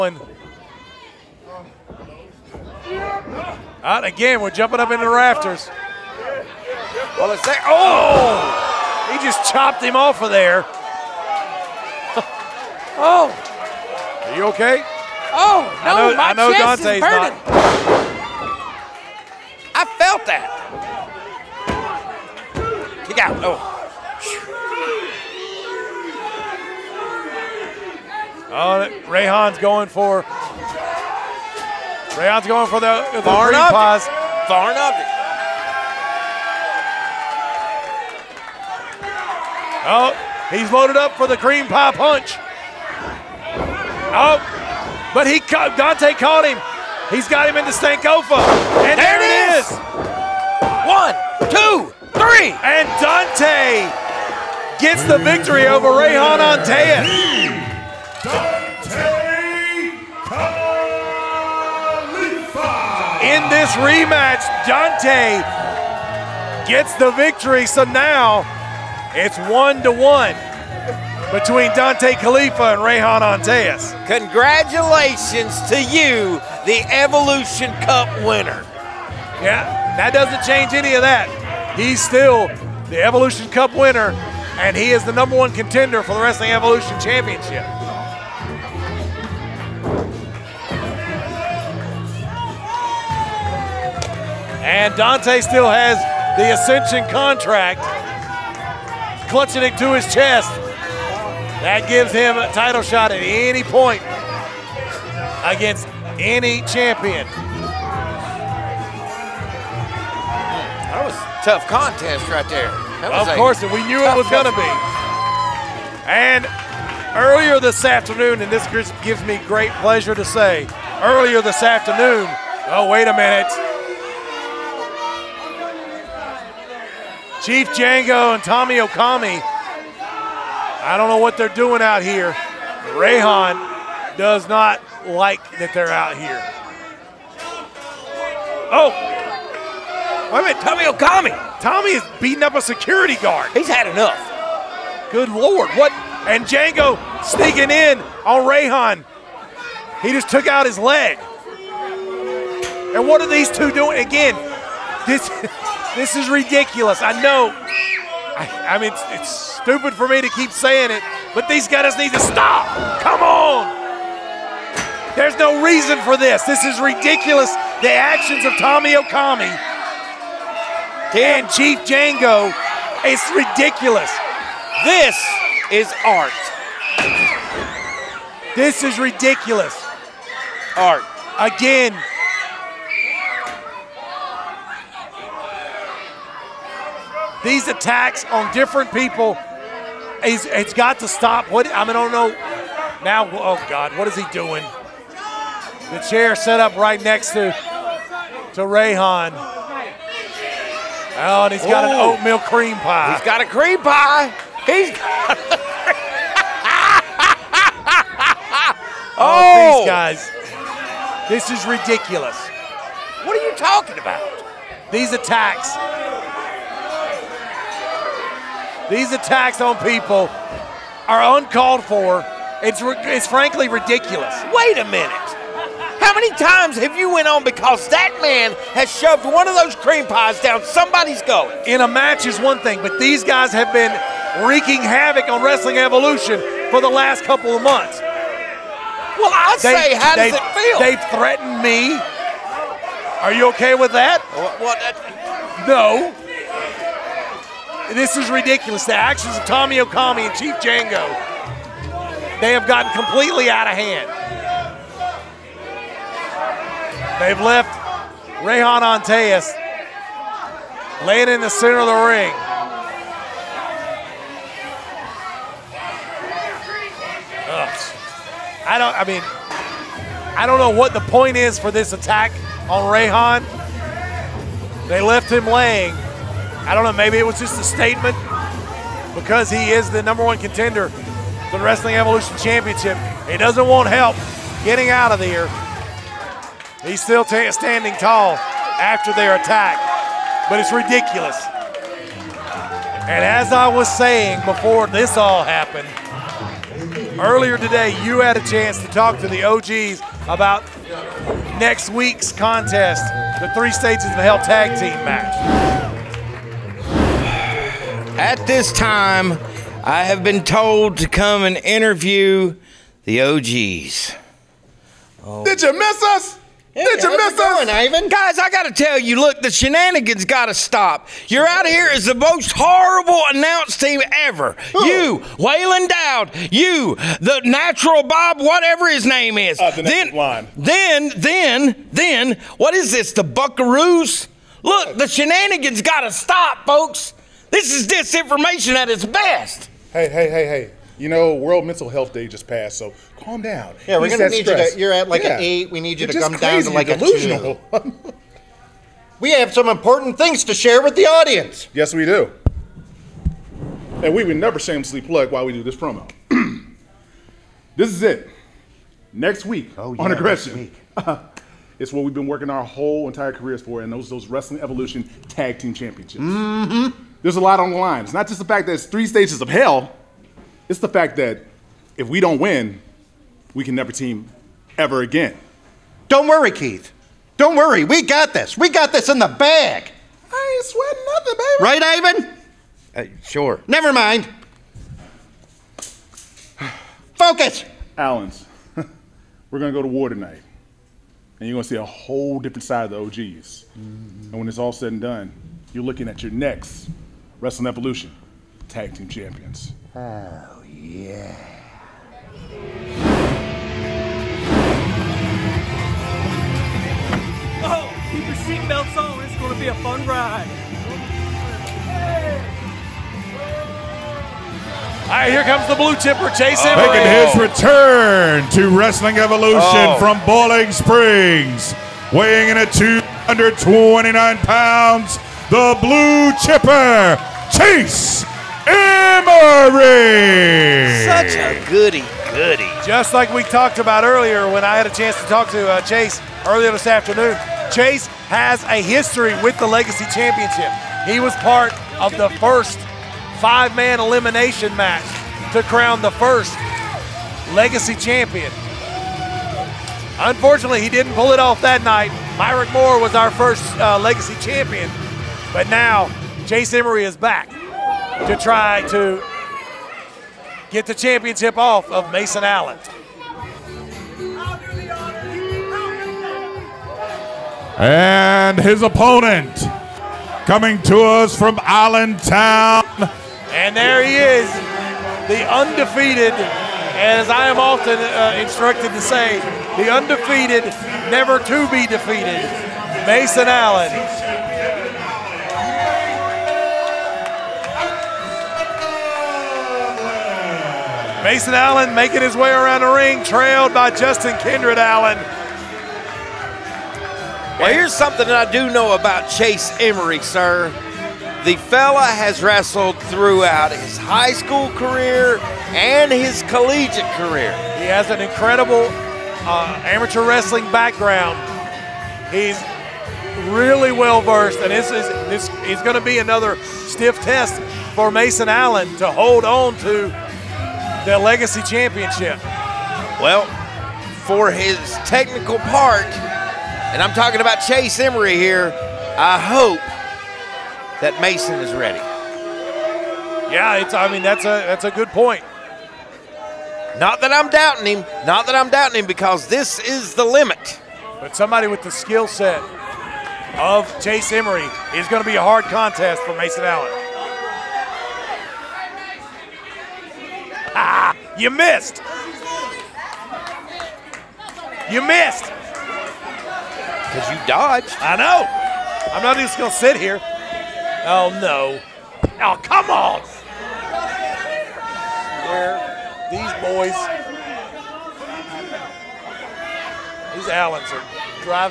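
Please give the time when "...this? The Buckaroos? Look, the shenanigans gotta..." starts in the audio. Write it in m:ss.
5:32.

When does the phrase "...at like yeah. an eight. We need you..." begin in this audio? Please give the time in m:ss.
5:44.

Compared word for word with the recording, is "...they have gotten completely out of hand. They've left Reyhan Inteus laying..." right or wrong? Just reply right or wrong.
right.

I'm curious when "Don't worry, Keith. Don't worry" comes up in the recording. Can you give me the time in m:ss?
6:16.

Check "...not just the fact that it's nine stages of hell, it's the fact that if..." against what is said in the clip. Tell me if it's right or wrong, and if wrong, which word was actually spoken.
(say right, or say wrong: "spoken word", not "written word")
wrong: "three", not "nine".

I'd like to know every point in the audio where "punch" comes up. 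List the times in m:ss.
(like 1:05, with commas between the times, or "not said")
0:41.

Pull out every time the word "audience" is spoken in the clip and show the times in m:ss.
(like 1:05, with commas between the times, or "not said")
5:51.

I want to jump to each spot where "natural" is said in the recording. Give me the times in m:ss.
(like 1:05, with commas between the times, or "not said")
5:27.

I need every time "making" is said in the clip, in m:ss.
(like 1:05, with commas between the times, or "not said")
6:56, 8:11.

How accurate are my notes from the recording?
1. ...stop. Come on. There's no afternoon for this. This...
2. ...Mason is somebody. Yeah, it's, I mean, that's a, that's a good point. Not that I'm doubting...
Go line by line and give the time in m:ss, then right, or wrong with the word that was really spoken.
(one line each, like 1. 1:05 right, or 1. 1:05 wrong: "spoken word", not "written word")
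1. 2:42 wrong: "reason", not "afternoon"
2. 8:51 wrong: "ready", not "somebody".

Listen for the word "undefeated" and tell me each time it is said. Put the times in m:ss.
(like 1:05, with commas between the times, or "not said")
7:55, 7:59.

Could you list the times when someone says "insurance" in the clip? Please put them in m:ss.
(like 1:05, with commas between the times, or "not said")
not said.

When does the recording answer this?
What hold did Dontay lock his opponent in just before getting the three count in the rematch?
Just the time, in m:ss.
0:47.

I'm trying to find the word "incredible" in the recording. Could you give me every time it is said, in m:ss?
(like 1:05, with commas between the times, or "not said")
8:28.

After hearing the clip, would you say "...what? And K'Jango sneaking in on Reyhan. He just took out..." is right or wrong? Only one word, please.
right.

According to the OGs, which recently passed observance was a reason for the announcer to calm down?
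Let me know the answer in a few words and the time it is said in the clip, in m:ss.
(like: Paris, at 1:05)
World Mental Health Day, at 5:41.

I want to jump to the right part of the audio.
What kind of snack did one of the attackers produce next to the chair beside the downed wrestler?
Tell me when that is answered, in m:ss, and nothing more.
3:22.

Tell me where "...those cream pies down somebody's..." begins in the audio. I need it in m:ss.
3:49.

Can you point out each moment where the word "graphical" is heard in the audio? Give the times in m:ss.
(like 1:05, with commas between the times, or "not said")
not said.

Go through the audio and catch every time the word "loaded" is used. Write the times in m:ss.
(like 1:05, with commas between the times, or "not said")
0:40.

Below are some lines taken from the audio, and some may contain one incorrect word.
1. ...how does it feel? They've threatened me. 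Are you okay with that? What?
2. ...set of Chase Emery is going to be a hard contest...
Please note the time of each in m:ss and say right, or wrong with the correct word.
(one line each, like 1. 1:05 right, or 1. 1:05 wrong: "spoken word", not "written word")
1. 3:59 right
2. 9:02 right.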